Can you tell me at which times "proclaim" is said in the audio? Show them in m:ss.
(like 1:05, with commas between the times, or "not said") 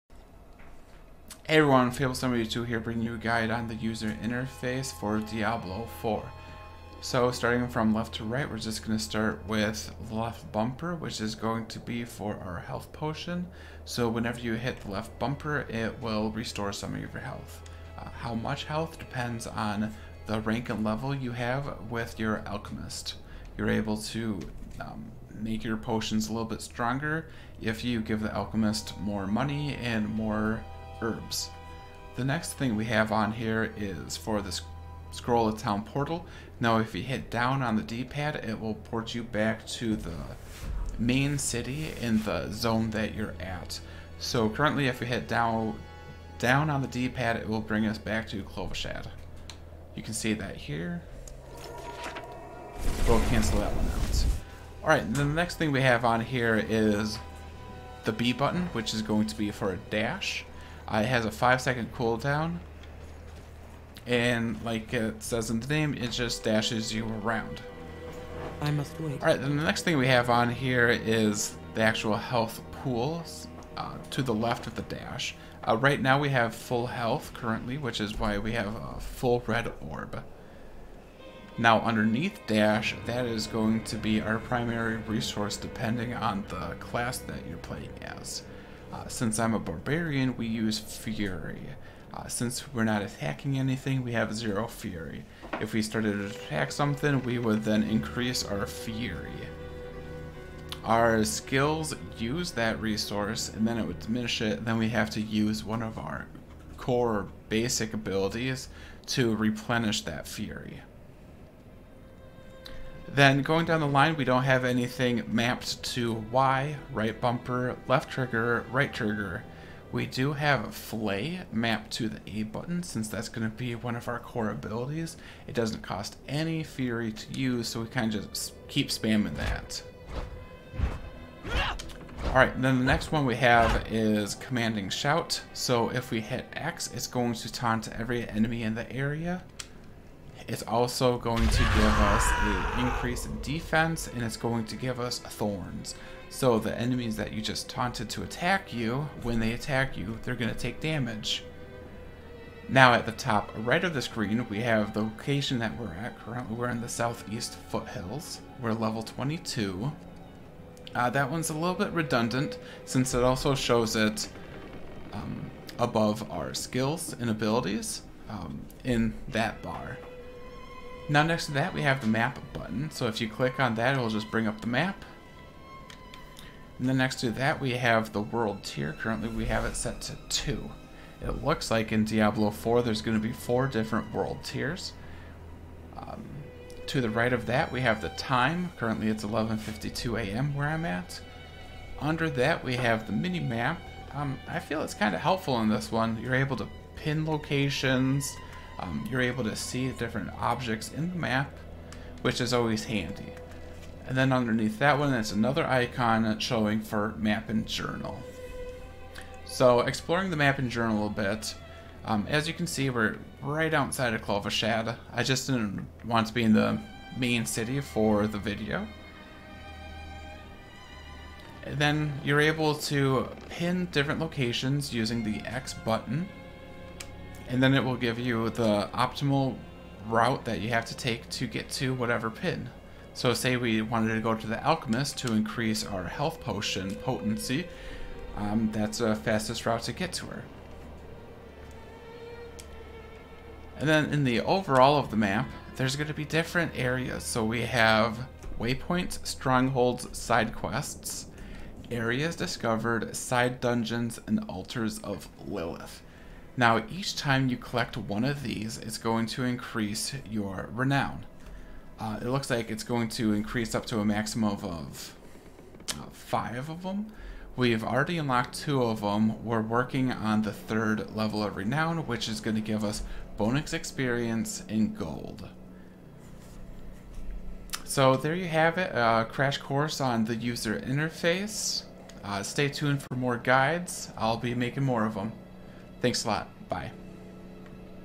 not said.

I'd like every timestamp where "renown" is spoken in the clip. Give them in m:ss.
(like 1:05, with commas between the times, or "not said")
4:20, 4:31.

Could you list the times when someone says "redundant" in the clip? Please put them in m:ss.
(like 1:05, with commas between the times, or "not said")
2:41.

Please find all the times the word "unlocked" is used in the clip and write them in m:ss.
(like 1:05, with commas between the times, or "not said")
4:28.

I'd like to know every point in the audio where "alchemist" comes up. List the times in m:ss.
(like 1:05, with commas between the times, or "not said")
0:22, 0:28, 3:54.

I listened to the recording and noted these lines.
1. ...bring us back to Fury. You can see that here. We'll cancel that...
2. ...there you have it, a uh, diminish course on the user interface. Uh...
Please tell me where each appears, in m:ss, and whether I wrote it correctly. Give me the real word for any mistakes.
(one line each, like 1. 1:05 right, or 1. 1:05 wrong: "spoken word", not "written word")
1. 0:47 wrong: "Kyovashad", not "Fury"
2. 4:38 wrong: "crash", not "diminish".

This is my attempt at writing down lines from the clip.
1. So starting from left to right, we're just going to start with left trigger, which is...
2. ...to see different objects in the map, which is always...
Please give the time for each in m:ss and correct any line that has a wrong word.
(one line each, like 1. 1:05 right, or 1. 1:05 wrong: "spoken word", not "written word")
1. 0:07 wrong: "bumper", not "trigger"
2. 3:19 right.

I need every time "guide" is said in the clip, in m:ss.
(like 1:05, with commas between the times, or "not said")
0:03, 4:43.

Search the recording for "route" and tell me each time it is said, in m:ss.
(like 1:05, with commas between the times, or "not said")
3:50, 3:59.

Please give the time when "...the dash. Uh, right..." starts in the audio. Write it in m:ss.
1:14.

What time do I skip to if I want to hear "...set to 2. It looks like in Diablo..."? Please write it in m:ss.
2:59.